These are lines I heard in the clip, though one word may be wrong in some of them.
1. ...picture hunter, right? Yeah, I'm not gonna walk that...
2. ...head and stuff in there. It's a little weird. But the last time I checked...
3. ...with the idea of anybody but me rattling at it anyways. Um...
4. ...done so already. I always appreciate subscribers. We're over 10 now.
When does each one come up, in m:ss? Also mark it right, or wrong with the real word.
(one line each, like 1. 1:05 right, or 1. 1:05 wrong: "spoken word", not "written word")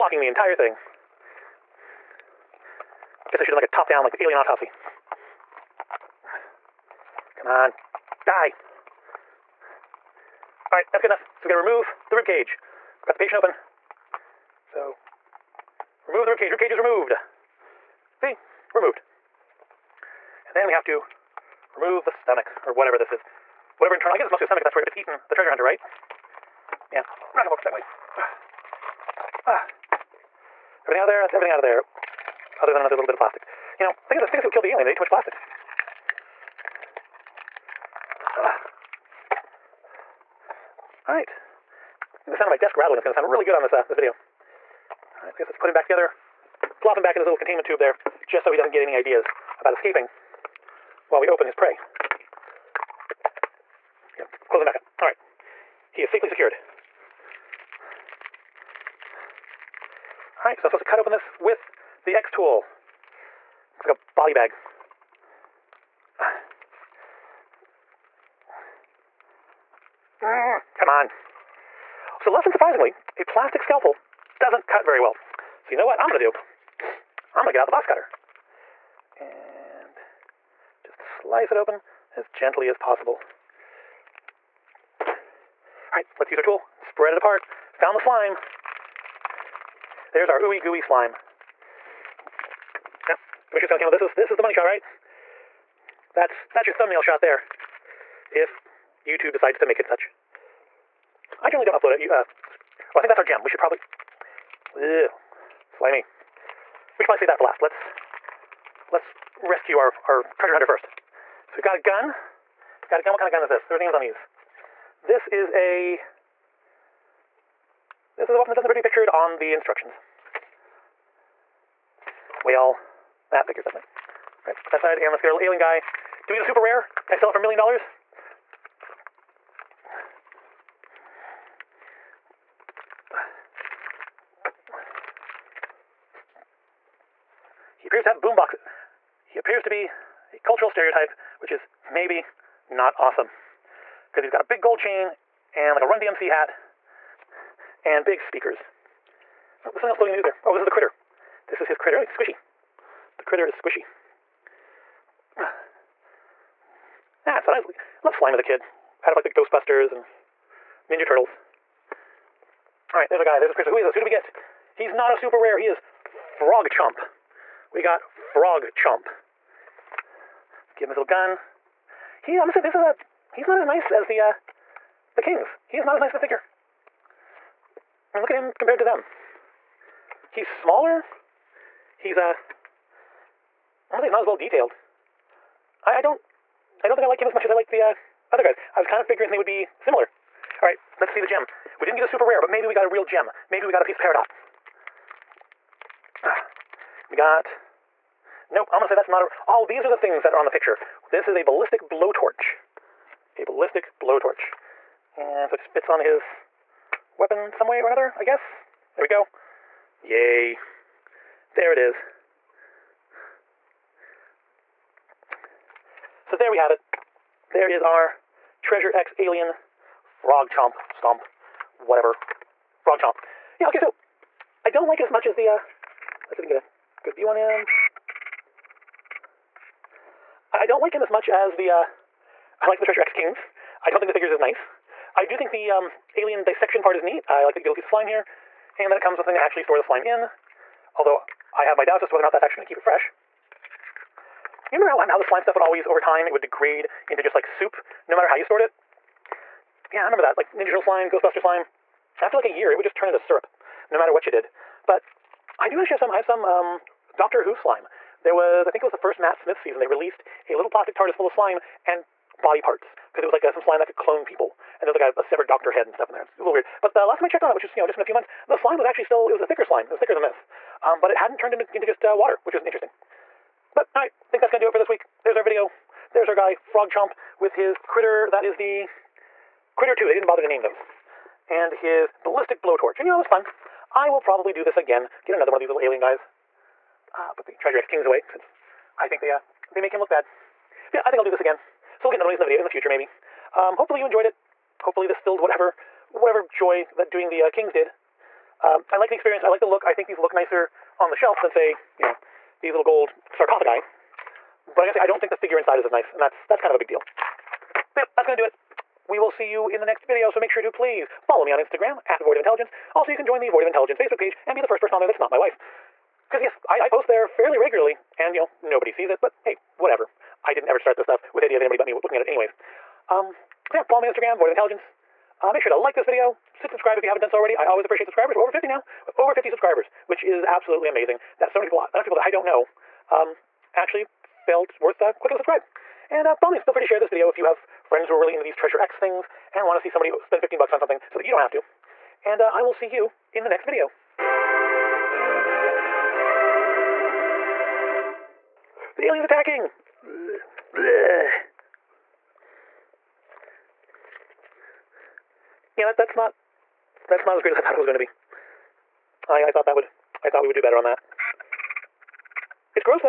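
1. 0:25 wrong: "treasure", not "picture"
2. 4:25 right
3. 5:21 wrong: "looking", not "rattling"
4. 5:27 wrong: "50", not "10".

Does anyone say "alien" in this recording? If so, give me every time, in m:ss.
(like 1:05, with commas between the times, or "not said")
0:04, 0:34, 2:05, 3:39, 3:56, 4:45, 5:49.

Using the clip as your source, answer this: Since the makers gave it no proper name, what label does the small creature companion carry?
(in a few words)
Critter 2.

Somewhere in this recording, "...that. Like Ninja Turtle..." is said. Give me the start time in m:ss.
4:10.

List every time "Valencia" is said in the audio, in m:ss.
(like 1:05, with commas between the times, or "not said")
not said.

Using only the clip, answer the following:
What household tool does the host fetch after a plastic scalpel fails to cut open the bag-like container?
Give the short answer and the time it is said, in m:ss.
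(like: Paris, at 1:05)
box cutter, at 1:17.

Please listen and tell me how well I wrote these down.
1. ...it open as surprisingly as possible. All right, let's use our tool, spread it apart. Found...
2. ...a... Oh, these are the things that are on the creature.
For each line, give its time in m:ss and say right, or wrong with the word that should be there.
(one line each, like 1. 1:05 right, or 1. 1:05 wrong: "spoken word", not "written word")
1. 1:21 wrong: "gently", not "surprisingly"
2. 3:19 wrong: "picture", not "creature".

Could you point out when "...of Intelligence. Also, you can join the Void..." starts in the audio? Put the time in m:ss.
5:12.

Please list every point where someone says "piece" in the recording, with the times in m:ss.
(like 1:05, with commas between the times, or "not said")
3:13, 3:57.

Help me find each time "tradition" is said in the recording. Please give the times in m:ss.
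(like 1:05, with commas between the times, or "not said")
not said.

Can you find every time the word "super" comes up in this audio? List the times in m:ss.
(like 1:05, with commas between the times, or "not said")
2:06, 2:45, 3:12.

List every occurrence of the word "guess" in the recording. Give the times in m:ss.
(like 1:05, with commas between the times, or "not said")
0:03, 0:24, 0:45, 3:28.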